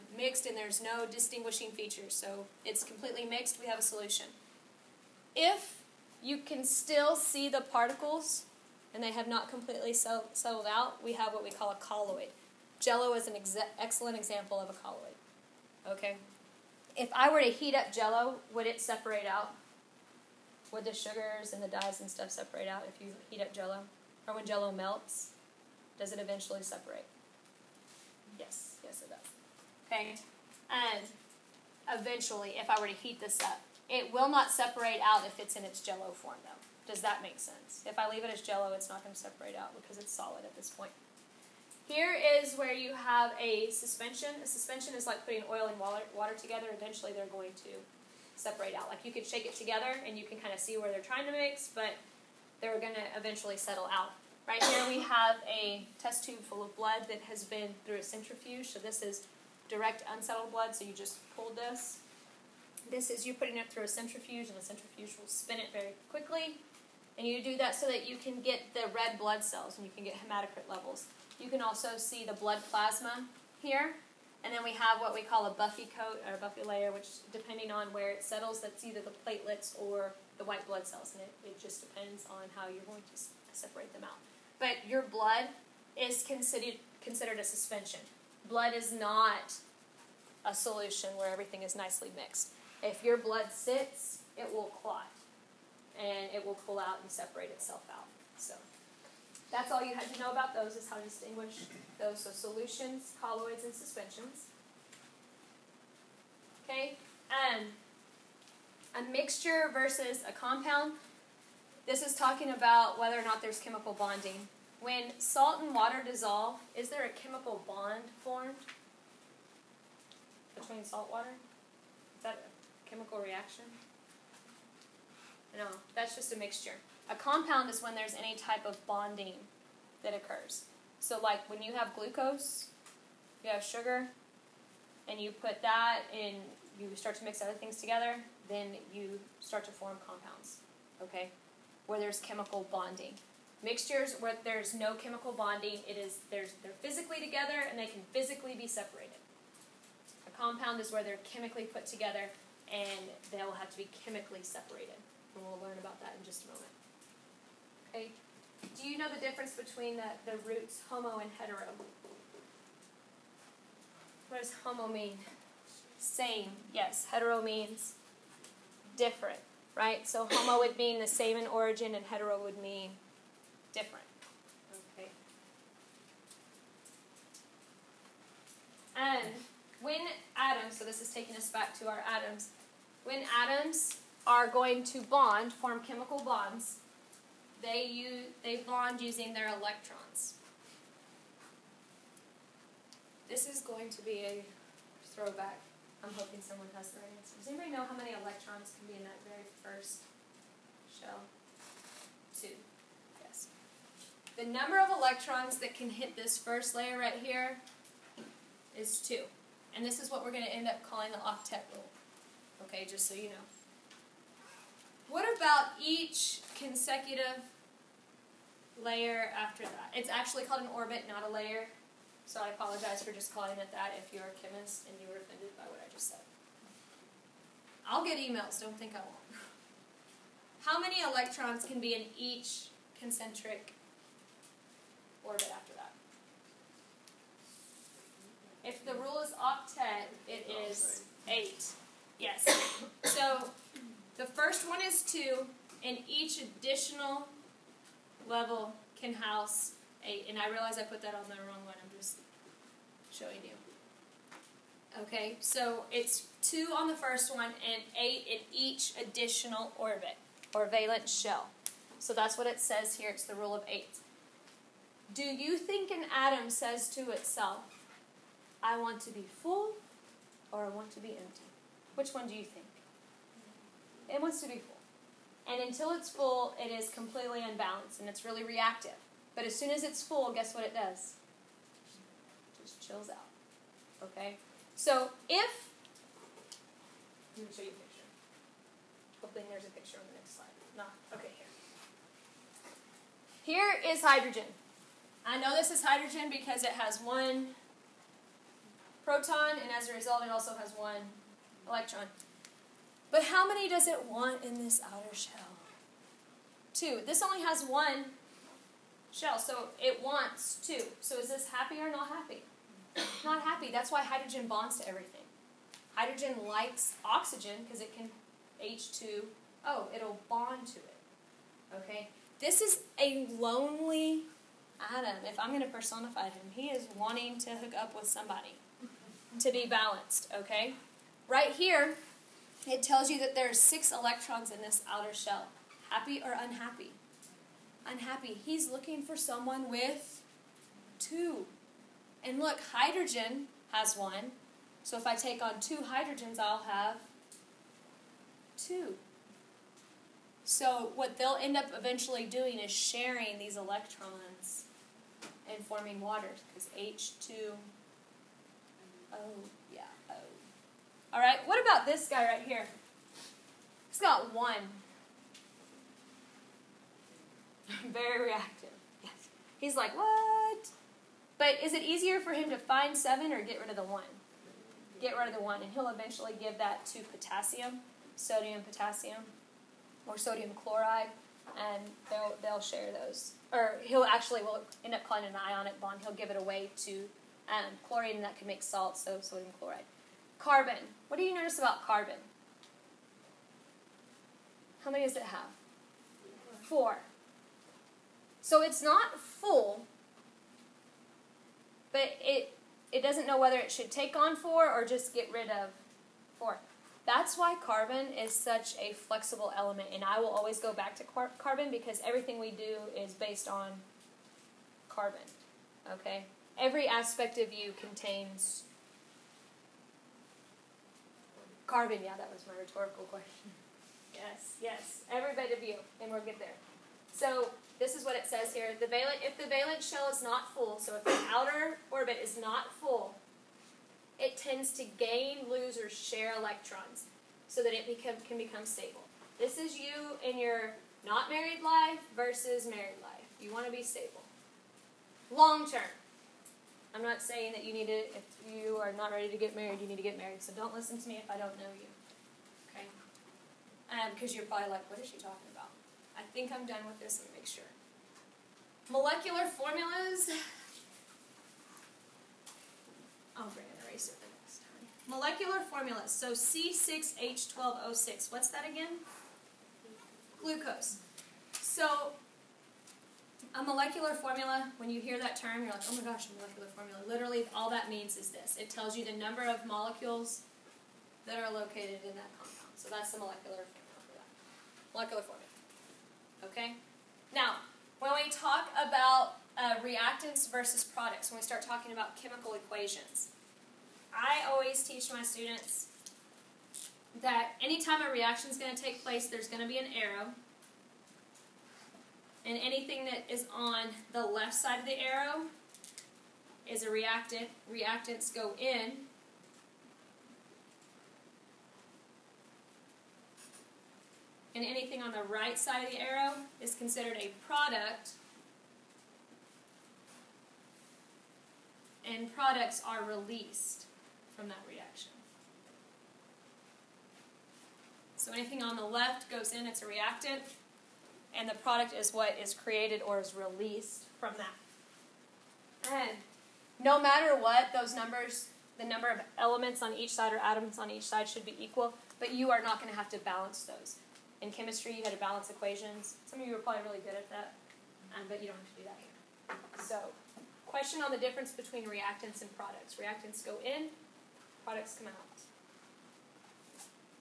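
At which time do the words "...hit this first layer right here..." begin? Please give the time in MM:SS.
03:25.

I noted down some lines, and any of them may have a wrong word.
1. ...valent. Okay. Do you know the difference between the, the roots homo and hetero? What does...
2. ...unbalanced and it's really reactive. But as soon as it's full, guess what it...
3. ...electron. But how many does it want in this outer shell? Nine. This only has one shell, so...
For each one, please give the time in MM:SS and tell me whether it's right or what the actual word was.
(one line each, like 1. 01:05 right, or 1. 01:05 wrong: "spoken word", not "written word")
1. 02:36 wrong: "moment", not "valent"
2. 04:37 right
3. 05:01 wrong: "Two", not "Nine".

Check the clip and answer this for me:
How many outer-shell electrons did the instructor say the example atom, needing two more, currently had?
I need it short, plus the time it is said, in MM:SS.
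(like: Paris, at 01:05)
6, at 05:33.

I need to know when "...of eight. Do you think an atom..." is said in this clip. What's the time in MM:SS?
04:23.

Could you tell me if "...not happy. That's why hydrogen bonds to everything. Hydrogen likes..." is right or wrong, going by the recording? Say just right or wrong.
right.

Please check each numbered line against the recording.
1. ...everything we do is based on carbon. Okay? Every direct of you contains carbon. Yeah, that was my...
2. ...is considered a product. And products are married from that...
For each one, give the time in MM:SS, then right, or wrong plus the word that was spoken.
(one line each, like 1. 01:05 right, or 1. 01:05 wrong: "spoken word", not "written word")
1. 06:52 wrong: "aspect", not "direct"
2. 08:36 wrong: "released", not "married".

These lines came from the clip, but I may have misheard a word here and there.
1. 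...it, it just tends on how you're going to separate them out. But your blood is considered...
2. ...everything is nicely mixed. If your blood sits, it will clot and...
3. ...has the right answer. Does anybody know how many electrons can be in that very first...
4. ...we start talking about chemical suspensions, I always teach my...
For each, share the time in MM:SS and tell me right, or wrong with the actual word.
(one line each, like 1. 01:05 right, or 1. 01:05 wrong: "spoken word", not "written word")
1. 01:21 wrong: "depends", not "tends"
2. 01:31 right
3. 03:16 right
4. 08:11 wrong: "equations", not "suspensions".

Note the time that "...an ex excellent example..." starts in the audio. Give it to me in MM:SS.
00:13.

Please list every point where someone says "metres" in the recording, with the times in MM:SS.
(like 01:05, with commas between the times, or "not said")
not said.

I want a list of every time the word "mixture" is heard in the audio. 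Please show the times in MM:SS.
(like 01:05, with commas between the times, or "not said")
01:49, 02:06, 02:23.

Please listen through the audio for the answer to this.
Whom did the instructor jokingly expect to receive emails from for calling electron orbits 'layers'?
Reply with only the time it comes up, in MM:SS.
03:43.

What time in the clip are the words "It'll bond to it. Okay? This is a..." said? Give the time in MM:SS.
05:19.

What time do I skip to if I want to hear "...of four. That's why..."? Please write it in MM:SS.
06:45.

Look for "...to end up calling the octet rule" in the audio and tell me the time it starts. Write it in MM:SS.
03:30.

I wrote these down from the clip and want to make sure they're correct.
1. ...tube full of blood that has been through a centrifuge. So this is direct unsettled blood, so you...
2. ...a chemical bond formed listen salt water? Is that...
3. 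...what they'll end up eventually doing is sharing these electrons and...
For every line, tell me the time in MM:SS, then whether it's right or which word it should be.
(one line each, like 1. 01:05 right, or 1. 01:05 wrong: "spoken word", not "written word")
1. 00:56 right
2. 01:57 wrong: "between", not "listen"
3. 05:50 right.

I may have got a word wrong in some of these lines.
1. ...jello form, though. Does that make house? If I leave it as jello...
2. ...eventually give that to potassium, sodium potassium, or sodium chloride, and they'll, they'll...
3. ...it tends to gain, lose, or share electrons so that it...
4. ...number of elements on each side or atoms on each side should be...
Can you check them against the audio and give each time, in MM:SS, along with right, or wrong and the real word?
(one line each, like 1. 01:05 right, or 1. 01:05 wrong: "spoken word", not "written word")
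1. 00:35 wrong: "sense", not "house"
2. 06:15 right
3. 07:14 right
4. 08:58 right.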